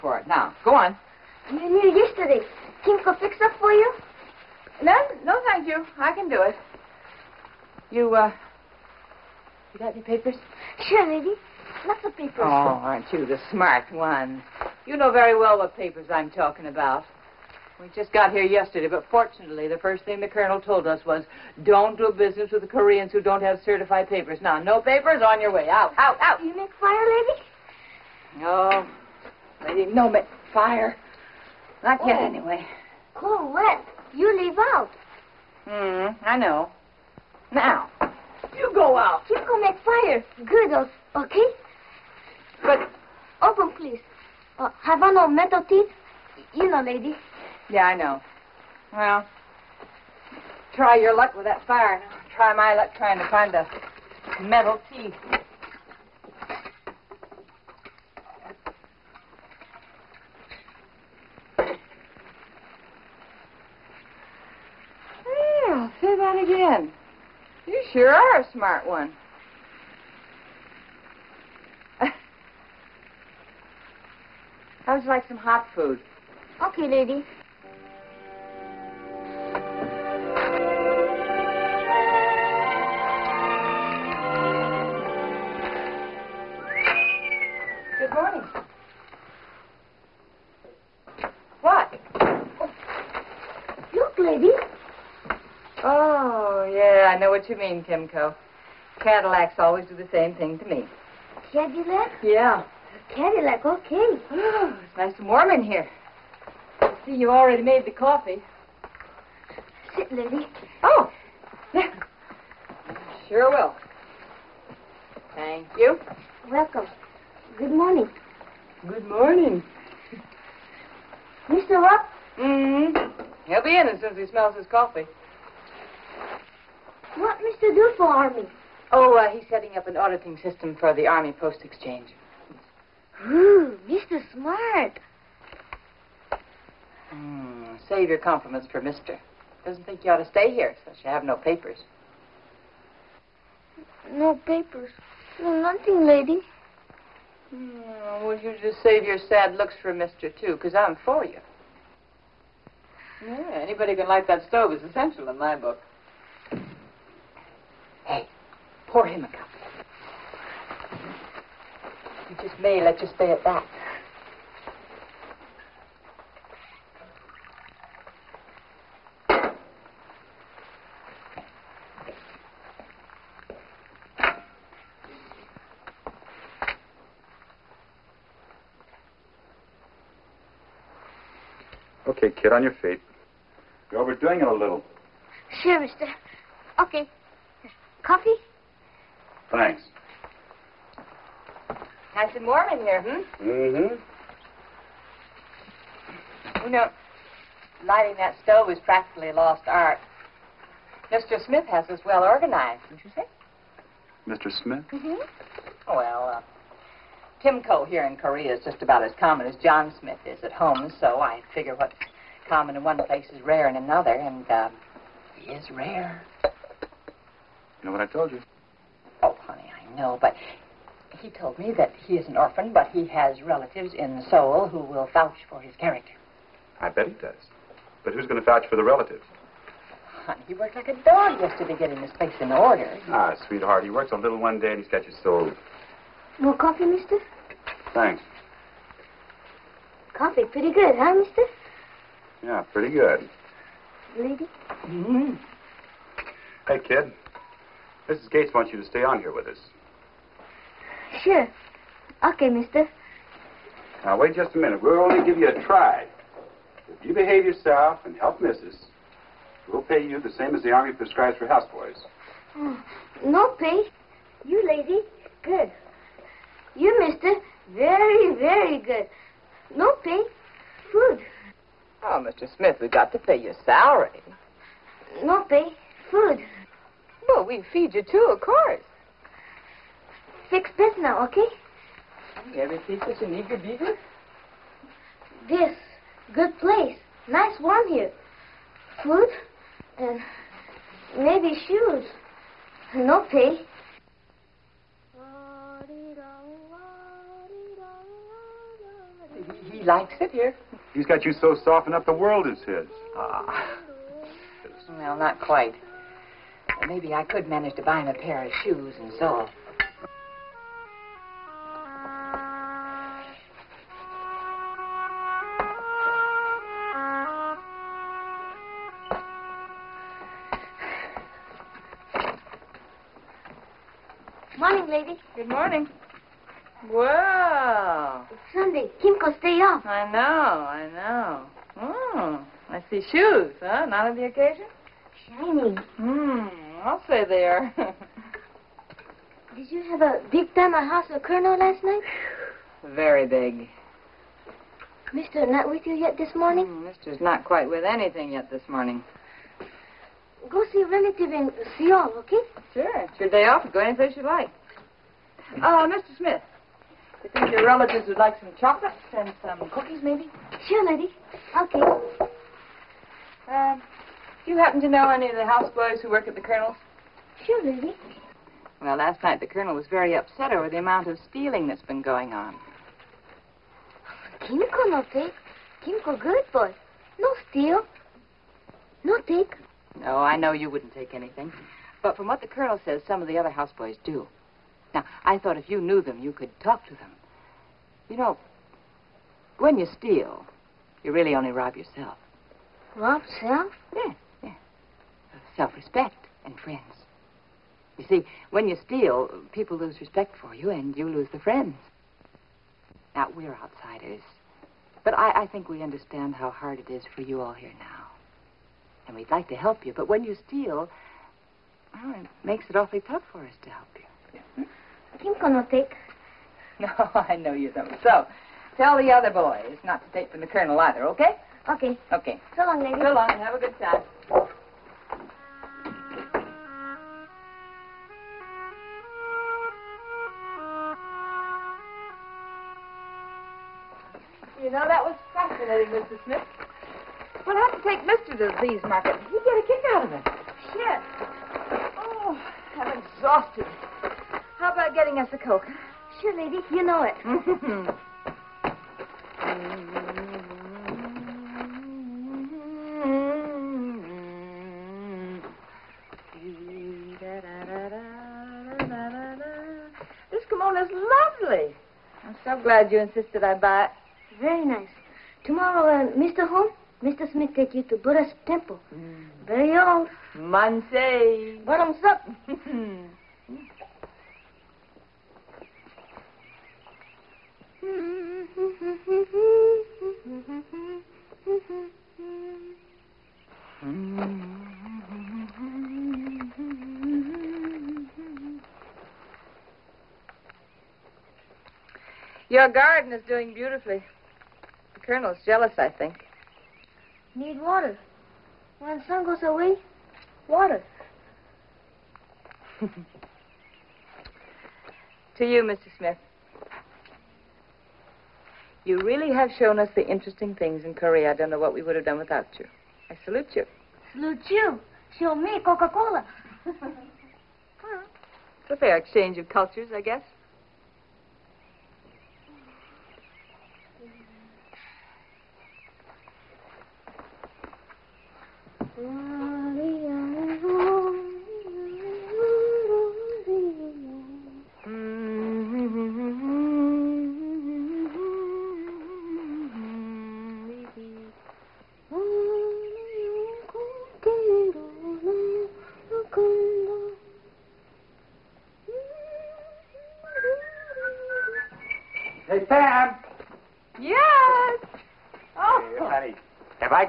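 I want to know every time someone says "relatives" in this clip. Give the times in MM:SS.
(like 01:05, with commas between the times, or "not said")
03:43, 03:48, 05:50, 05:57.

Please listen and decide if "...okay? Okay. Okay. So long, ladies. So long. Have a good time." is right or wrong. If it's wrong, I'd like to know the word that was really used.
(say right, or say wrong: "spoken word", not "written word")
right.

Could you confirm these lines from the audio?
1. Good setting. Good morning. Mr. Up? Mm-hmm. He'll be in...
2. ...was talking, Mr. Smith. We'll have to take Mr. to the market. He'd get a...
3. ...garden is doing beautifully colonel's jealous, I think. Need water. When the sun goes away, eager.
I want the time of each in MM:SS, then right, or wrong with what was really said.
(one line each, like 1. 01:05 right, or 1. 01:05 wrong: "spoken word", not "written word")
1. 01:57 wrong: "morning", not "setting"
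2. 07:15 wrong: "fascinating", not "talking"
3. 08:12 wrong: "water", not "eager".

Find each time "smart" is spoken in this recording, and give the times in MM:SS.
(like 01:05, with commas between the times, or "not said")
00:13, 01:08, 02:14.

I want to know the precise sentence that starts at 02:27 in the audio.
Mm, would you just save your sad looks for Mr.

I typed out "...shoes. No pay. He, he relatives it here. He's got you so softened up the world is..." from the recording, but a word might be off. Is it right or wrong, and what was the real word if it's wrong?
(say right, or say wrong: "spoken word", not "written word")
wrong: "likes", not "relatives".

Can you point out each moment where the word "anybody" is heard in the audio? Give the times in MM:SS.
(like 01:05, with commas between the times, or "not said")
02:33.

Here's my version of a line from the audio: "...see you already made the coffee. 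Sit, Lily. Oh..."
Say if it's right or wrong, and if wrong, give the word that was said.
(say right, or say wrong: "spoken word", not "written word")
right.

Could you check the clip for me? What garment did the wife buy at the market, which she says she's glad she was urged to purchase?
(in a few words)
kimono.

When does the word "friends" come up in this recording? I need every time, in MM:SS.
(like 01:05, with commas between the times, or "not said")
06:36, 06:41.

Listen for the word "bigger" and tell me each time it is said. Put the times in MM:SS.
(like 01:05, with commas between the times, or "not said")
not said.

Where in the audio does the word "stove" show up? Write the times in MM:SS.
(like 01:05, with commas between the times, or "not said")
02:34, 03:18.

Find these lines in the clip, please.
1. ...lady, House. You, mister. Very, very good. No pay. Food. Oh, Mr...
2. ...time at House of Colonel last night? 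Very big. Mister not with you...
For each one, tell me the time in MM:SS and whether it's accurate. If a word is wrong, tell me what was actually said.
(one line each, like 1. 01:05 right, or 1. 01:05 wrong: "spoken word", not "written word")
1. 04:24 wrong: "Good", not "House"
2. 05:40 right.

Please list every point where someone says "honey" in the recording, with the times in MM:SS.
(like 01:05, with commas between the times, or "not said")
03:39, 03:50, 09:15.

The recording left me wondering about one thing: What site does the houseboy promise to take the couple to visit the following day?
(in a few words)
Buddha's temple.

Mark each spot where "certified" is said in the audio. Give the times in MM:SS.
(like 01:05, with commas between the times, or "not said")
00:23.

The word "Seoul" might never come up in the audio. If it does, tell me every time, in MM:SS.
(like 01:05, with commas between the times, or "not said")
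03:44, 05:51.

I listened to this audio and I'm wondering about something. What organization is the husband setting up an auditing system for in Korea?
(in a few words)
Army Post Exchange.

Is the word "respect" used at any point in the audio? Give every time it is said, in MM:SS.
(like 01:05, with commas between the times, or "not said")
06:35, 06:40.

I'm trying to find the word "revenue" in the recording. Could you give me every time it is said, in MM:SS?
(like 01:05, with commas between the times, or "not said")
not said.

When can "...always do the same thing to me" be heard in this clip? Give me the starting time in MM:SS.
01:39.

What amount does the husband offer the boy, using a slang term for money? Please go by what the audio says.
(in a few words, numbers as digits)
six bits.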